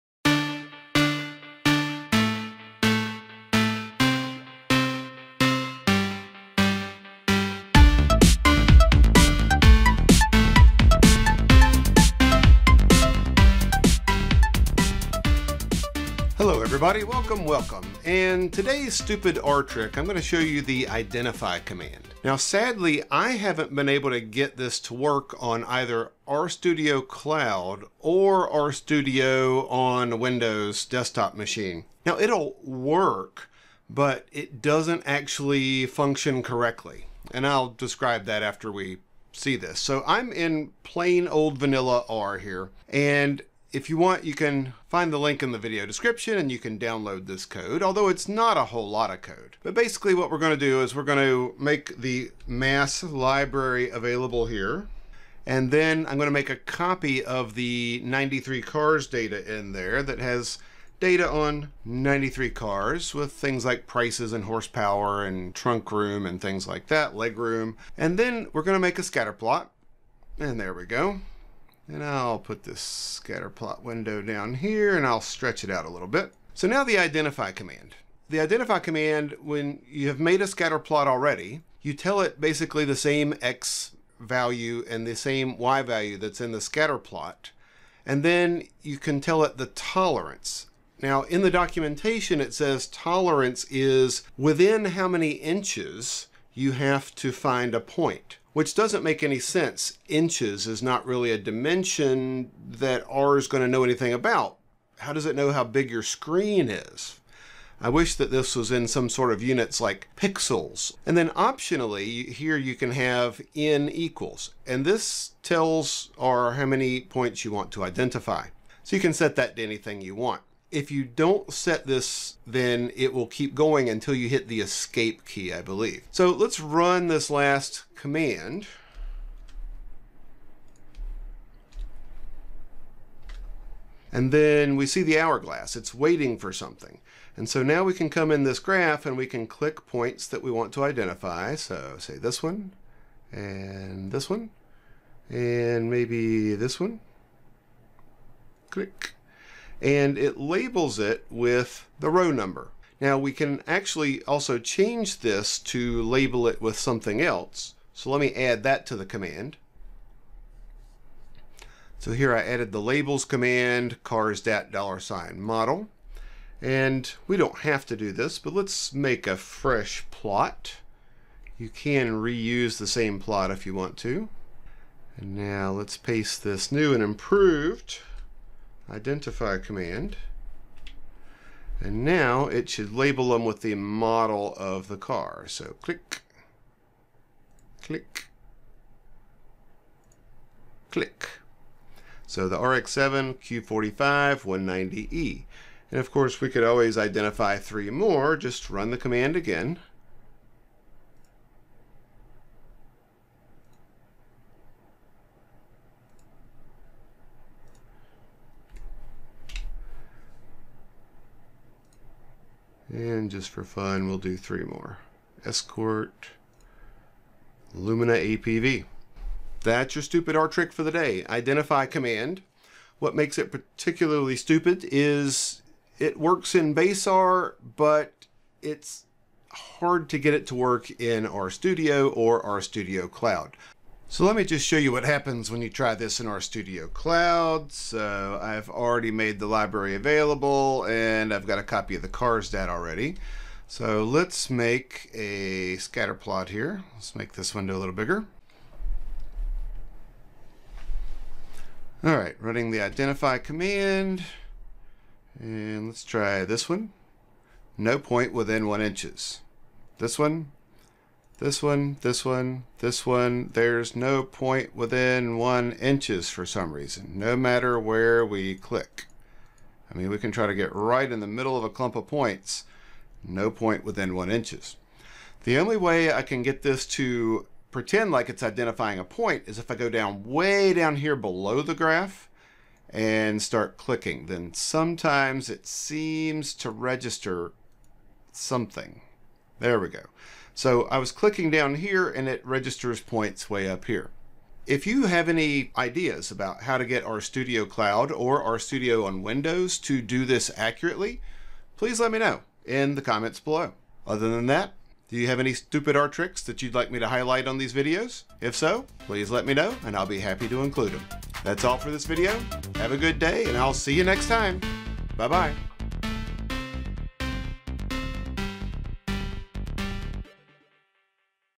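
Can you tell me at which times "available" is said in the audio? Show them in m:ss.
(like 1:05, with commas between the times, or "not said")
0:53, 3:59.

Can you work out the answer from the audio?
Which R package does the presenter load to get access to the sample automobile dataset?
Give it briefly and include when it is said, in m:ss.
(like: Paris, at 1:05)
MASS, at 0:52.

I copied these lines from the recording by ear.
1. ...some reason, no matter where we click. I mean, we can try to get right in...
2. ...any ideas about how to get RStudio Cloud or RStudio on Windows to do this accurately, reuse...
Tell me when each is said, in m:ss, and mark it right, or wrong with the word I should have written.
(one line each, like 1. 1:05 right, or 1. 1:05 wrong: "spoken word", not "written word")
1. 4:26 right
2. 4:55 wrong: "please", not "reuse".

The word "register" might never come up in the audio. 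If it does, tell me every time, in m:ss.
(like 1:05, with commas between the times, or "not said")
4:46, 4:52.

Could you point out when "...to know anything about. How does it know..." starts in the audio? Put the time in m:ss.
1:43.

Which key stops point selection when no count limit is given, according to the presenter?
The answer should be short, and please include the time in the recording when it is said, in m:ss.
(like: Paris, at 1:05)
Escape key, at 2:04.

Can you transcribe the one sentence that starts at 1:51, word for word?
And then optionally, here you can have n equals.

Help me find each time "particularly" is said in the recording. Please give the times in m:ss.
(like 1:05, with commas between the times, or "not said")
3:43.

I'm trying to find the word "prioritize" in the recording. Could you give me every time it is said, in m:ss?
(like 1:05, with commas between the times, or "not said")
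not said.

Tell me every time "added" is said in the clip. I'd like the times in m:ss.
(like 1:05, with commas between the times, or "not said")
2:42.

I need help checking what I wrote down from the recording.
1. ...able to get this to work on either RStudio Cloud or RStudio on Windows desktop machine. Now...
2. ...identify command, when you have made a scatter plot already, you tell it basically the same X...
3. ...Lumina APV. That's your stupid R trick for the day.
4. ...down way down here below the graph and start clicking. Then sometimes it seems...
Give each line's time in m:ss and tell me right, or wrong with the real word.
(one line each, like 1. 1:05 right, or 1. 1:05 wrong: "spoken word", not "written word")
1. 0:23 right
2. 1:18 right
3. 3:37 right
4. 4:39 right.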